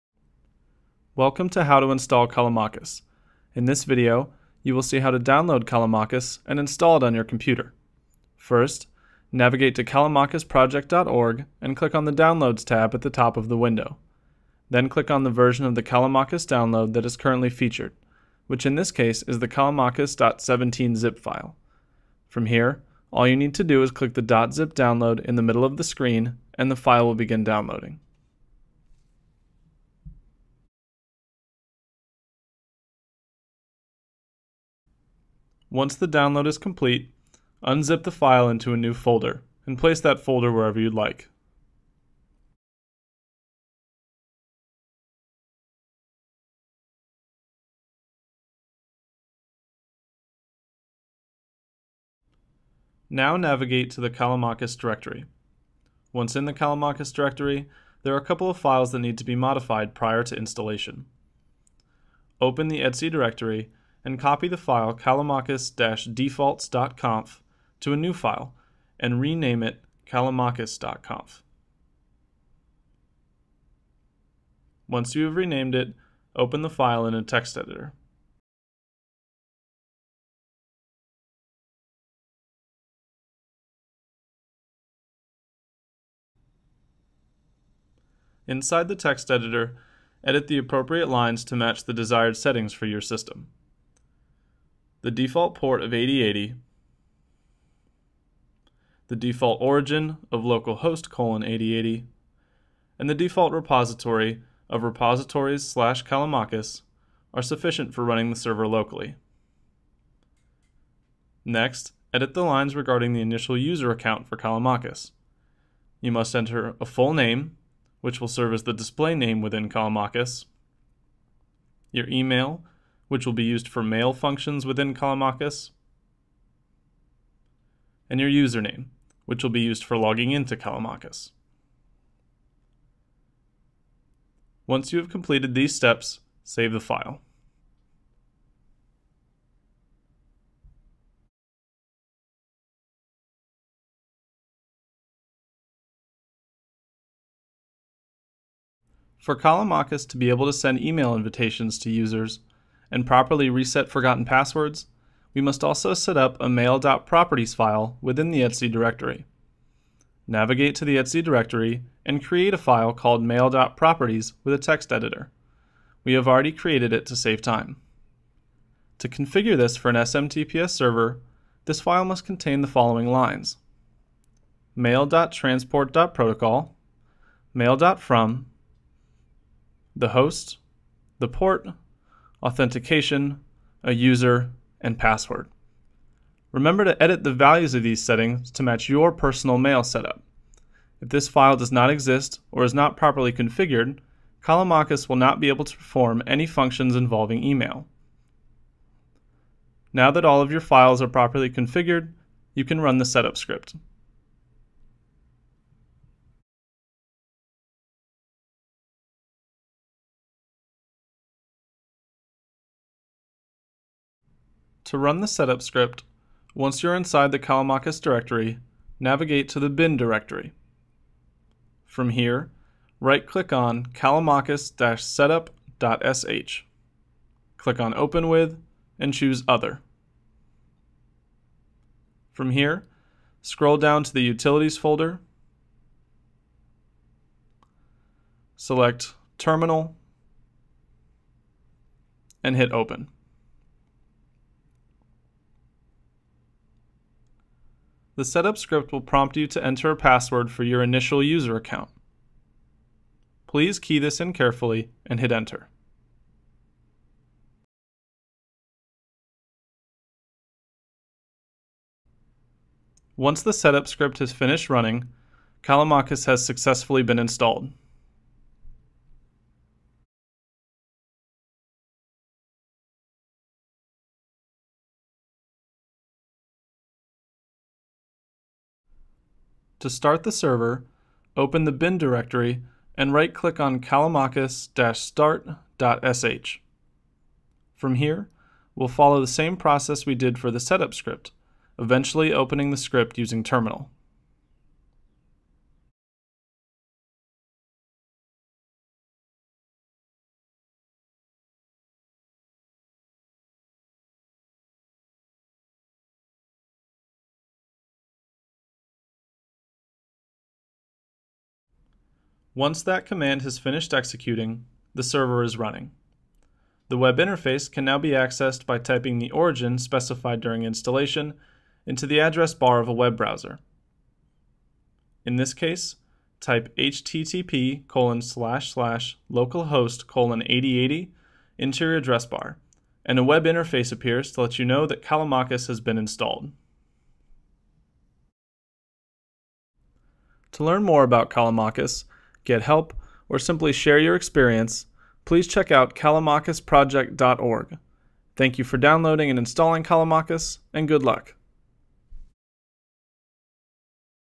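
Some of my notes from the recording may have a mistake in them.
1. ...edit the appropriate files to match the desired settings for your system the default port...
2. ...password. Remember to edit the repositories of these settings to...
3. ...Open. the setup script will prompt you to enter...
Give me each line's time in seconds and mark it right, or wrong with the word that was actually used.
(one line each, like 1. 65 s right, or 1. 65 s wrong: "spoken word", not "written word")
1. 90 s wrong: "lines", not "files"
2. 184 s wrong: "values", not "repositories"
3. 242 s right.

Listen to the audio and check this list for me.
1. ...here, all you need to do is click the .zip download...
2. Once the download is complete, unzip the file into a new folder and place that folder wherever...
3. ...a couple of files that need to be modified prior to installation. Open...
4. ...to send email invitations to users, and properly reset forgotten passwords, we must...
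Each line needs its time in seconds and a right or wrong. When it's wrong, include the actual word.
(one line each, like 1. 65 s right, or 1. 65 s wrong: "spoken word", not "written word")
1. 22 s right
2. 35 s right
3. 58 s right
4. 150 s right.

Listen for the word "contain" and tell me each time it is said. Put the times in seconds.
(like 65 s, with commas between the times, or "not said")
172 s.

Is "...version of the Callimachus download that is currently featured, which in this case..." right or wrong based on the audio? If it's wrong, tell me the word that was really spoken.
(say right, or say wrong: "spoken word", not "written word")
right.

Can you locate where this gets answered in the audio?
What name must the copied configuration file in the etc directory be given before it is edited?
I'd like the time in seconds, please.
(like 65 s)
70 s.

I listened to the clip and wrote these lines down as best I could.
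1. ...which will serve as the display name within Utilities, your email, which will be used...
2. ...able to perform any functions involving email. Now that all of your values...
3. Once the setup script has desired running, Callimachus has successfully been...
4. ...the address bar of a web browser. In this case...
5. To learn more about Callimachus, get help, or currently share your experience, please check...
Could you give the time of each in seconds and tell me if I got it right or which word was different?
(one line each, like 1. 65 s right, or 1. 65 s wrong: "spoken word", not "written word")
1. 118 s wrong: "Callimachus", not "Utilities"
2. 195 s wrong: "files", not "values"
3. 263 s wrong: "finished", not "desired"
4. 322 s right
5. 340 s wrong: "simply", not "currently".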